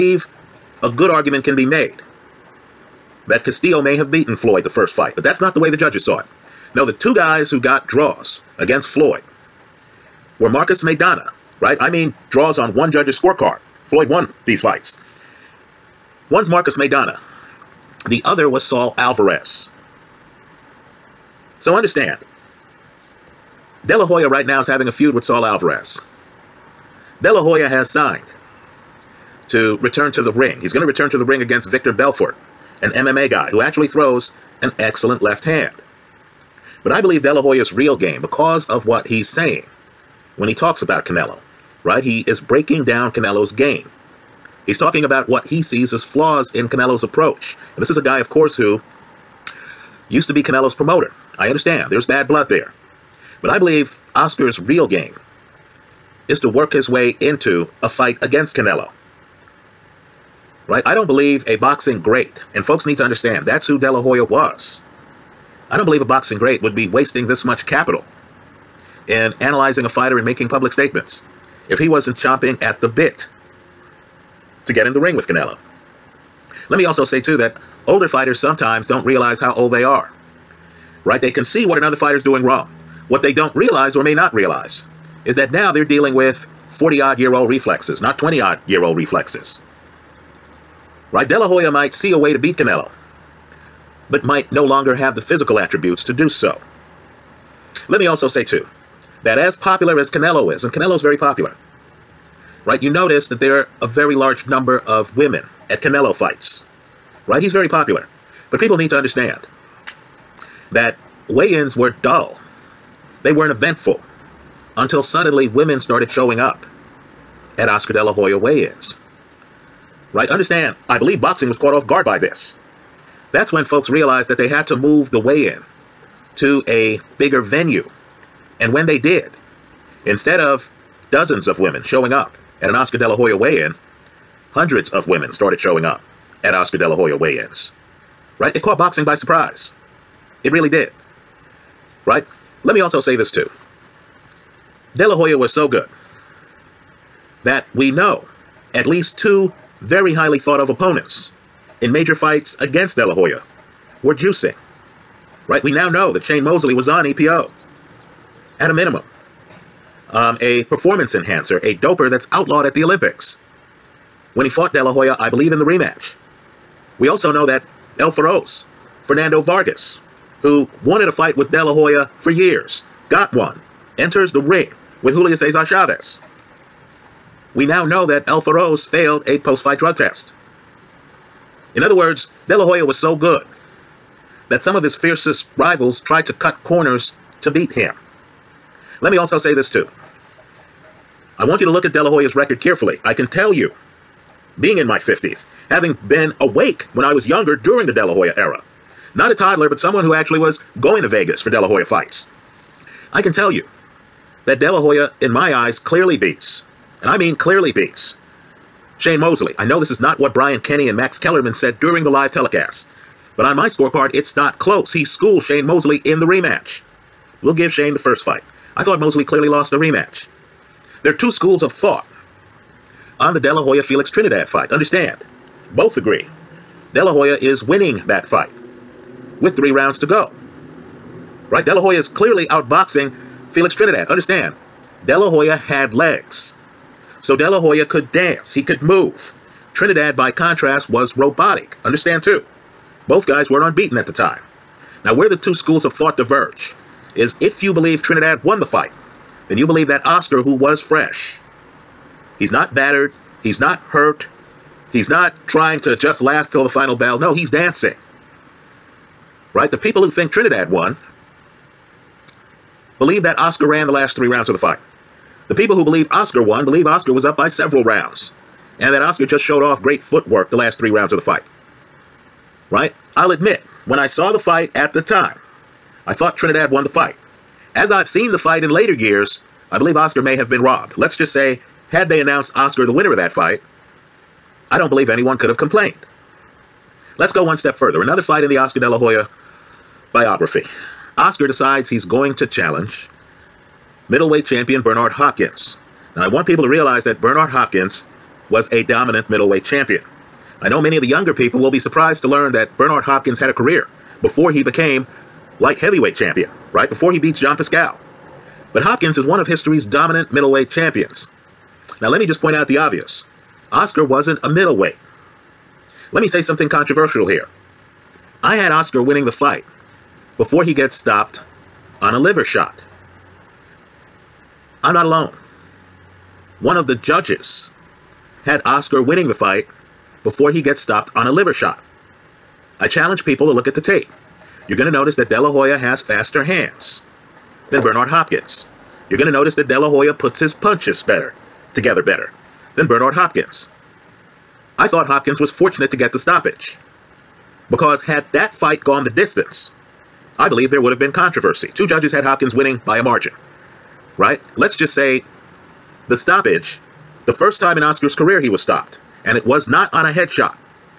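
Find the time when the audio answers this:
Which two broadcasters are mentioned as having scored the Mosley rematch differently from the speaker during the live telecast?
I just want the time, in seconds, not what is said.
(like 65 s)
210 s.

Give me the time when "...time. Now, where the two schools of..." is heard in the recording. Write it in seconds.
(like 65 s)
244 s.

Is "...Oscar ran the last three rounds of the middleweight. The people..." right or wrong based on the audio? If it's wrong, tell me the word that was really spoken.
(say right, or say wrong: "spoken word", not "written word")
wrong: "fight", not "middleweight".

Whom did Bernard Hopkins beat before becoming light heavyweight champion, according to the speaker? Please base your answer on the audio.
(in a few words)
John Pascal.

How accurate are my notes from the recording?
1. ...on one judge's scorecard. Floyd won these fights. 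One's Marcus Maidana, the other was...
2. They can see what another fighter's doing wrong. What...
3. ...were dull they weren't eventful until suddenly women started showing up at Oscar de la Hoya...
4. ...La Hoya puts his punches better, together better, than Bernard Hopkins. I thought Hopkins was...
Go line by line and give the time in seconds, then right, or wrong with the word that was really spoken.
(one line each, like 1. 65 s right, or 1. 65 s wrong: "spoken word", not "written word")
1. 12 s right
2. 81 s right
3. 111 s right
4. 339 s right.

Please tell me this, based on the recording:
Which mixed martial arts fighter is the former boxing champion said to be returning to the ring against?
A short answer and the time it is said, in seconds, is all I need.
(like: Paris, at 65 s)
Victor Belfort, at 31 s.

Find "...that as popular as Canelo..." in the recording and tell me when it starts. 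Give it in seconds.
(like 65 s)
99 s.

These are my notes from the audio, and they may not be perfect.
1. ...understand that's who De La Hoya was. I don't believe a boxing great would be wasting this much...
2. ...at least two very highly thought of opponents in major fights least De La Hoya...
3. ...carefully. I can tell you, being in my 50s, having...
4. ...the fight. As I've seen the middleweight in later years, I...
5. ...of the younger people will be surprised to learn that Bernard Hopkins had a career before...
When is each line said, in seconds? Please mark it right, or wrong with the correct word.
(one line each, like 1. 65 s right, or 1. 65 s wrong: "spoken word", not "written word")
1. 63 s right
2. 148 s wrong: "against", not "least"
3. 192 s right
4. 276 s wrong: "fight", not "middleweight"
5. 300 s right.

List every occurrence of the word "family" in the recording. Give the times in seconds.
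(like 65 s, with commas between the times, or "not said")
not said.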